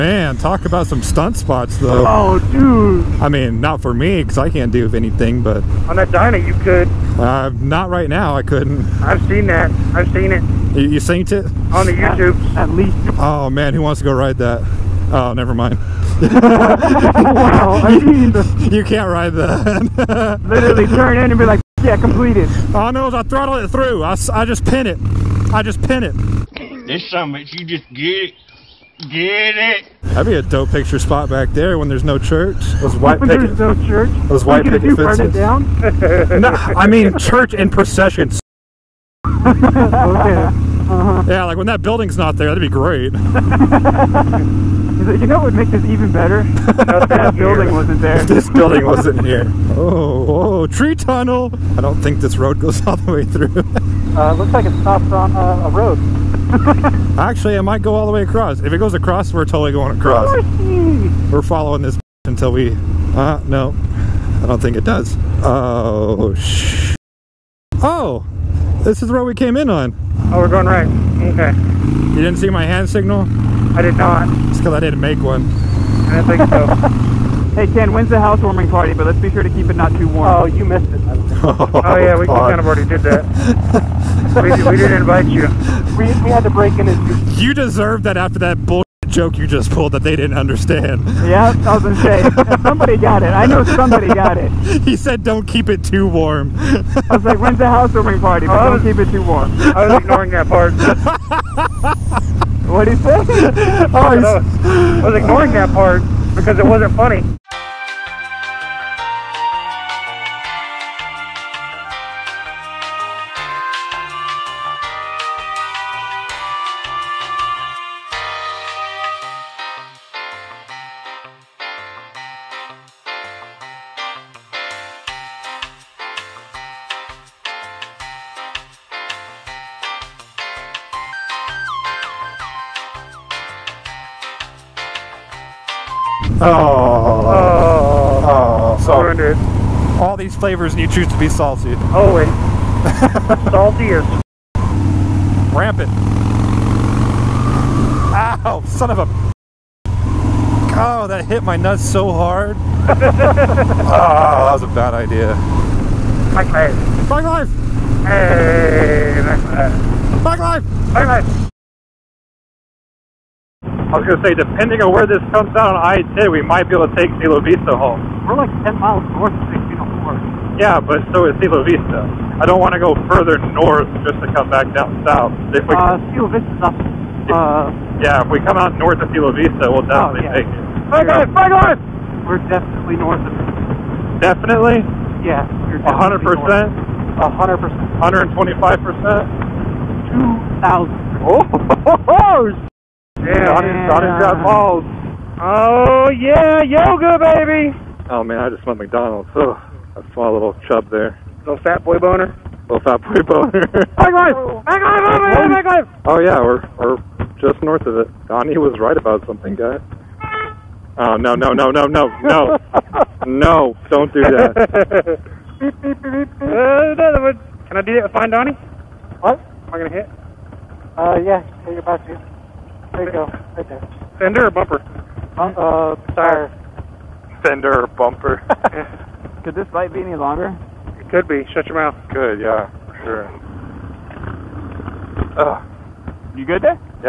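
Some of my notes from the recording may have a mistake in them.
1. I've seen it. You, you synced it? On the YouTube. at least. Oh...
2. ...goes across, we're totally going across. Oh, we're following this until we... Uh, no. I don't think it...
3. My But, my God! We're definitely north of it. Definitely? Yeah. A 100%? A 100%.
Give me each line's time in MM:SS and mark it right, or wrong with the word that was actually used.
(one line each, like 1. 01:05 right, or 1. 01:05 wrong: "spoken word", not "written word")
1. 00:09 right
2. 00:58 right
3. 03:00 wrong: "God", not "But".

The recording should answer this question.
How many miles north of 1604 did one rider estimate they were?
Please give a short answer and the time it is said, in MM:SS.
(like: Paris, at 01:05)
10, at 02:48.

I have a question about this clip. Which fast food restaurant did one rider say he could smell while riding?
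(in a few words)
McDonald's.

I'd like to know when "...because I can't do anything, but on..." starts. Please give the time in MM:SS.
00:04.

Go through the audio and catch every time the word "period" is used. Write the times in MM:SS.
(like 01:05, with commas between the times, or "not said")
not said.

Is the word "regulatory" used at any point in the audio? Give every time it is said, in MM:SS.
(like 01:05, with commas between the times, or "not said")
not said.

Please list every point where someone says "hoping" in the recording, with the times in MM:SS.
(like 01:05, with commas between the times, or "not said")
not said.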